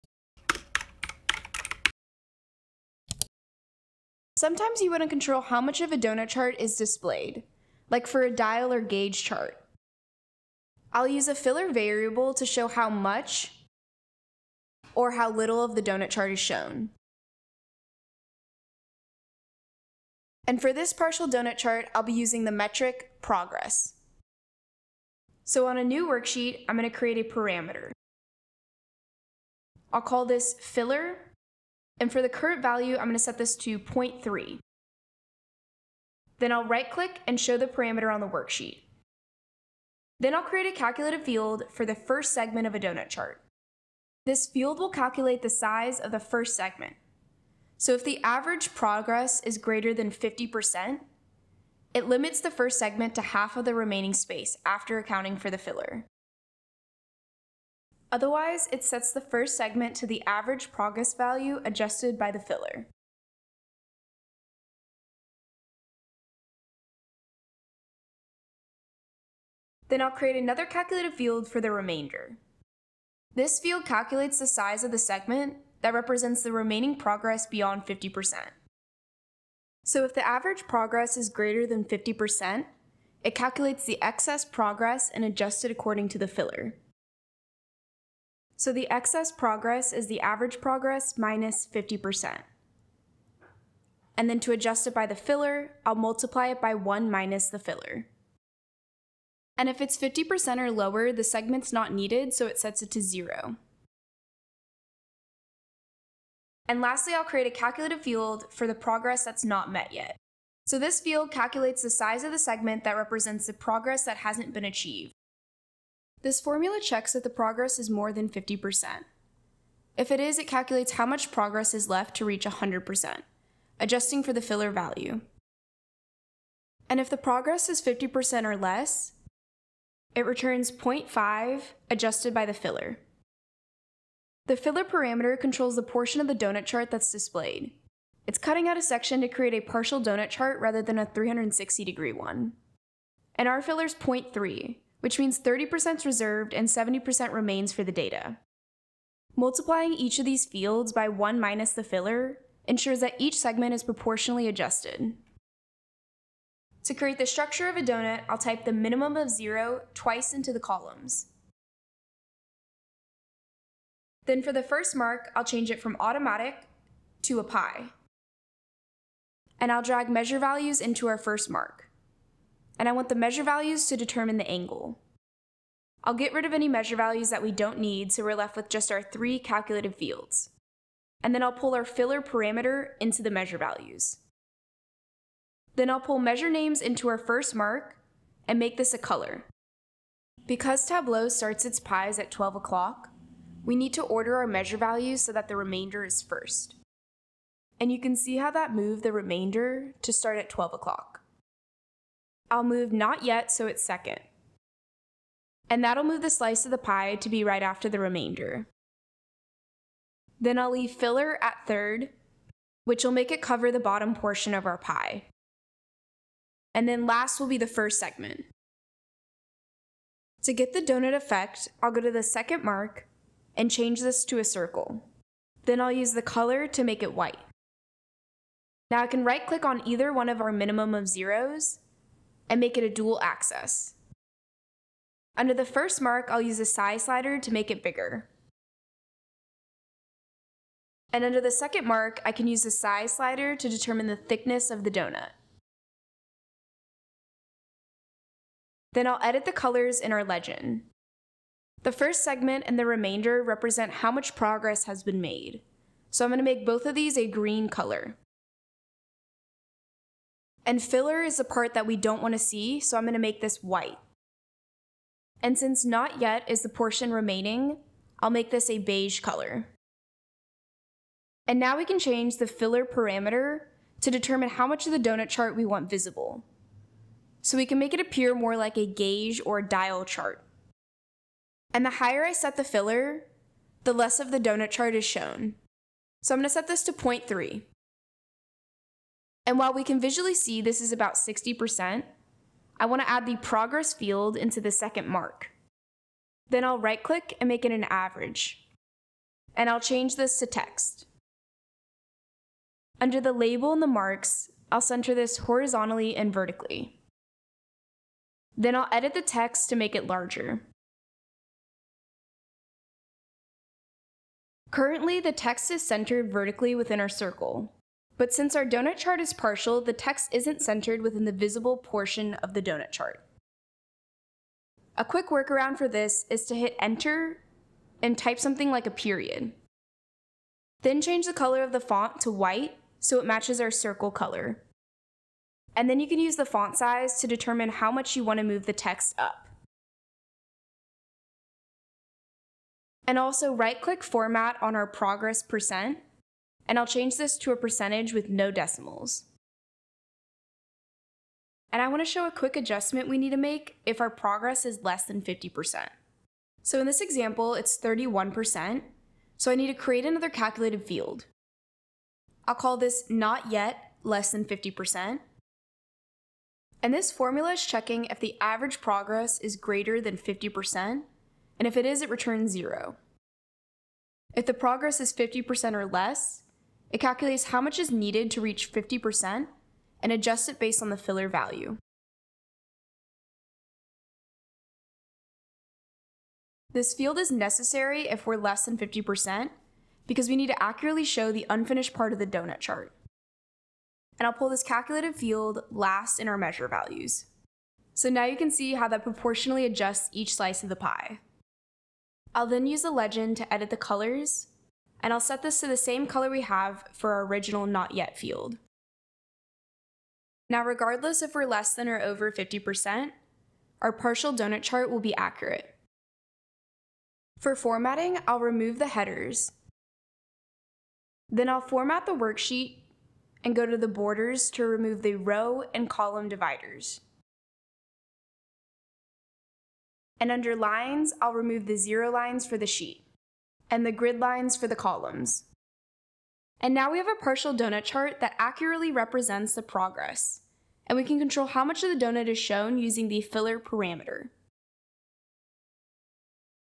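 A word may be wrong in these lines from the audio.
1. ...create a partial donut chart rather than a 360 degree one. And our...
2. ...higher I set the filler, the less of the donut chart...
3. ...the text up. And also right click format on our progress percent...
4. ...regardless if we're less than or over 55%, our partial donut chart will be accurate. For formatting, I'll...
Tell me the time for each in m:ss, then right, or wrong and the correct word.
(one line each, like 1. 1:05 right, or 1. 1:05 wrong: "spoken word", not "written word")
1. 2:19 right
2. 4:41 right
3. 5:38 right
4. 6:50 wrong: "50", not "55".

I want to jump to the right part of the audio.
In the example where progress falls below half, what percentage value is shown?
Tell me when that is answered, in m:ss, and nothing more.
5:57.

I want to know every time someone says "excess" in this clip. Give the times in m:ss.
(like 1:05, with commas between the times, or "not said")
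1:24, 1:28.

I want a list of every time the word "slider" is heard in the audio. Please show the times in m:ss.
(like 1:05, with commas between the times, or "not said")
3:57, 4:03.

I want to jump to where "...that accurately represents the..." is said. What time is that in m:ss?
7:18.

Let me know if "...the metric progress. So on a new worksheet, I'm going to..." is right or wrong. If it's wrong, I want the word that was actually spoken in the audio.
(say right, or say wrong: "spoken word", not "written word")
right.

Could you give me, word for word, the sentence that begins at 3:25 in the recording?
And that'll move the slice of the pie to be right after the remainder.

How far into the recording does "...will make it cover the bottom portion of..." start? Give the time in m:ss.
3:33.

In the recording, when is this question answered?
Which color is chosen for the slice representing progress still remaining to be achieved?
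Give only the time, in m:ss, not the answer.
4:28.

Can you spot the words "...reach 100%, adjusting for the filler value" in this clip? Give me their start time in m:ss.
2:02.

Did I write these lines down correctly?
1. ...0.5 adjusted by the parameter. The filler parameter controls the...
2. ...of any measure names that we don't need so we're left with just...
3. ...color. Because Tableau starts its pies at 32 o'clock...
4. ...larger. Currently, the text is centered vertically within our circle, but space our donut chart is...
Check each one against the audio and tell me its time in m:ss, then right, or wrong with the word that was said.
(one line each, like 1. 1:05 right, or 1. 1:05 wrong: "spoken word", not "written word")
1. 2:10 wrong: "filler", not "parameter"
2. 2:56 wrong: "values", not "names"
3. 3:08 wrong: "12", not "32"
4. 5:10 wrong: "since", not "space".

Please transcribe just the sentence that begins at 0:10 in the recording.
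I'll use a filler variable to show how much or how little of the donut chart is shown.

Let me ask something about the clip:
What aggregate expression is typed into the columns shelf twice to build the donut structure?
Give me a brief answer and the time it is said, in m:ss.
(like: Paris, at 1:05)
minimum of 0, at 2:38.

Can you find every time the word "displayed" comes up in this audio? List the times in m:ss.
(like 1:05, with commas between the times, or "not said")
0:06, 2:17.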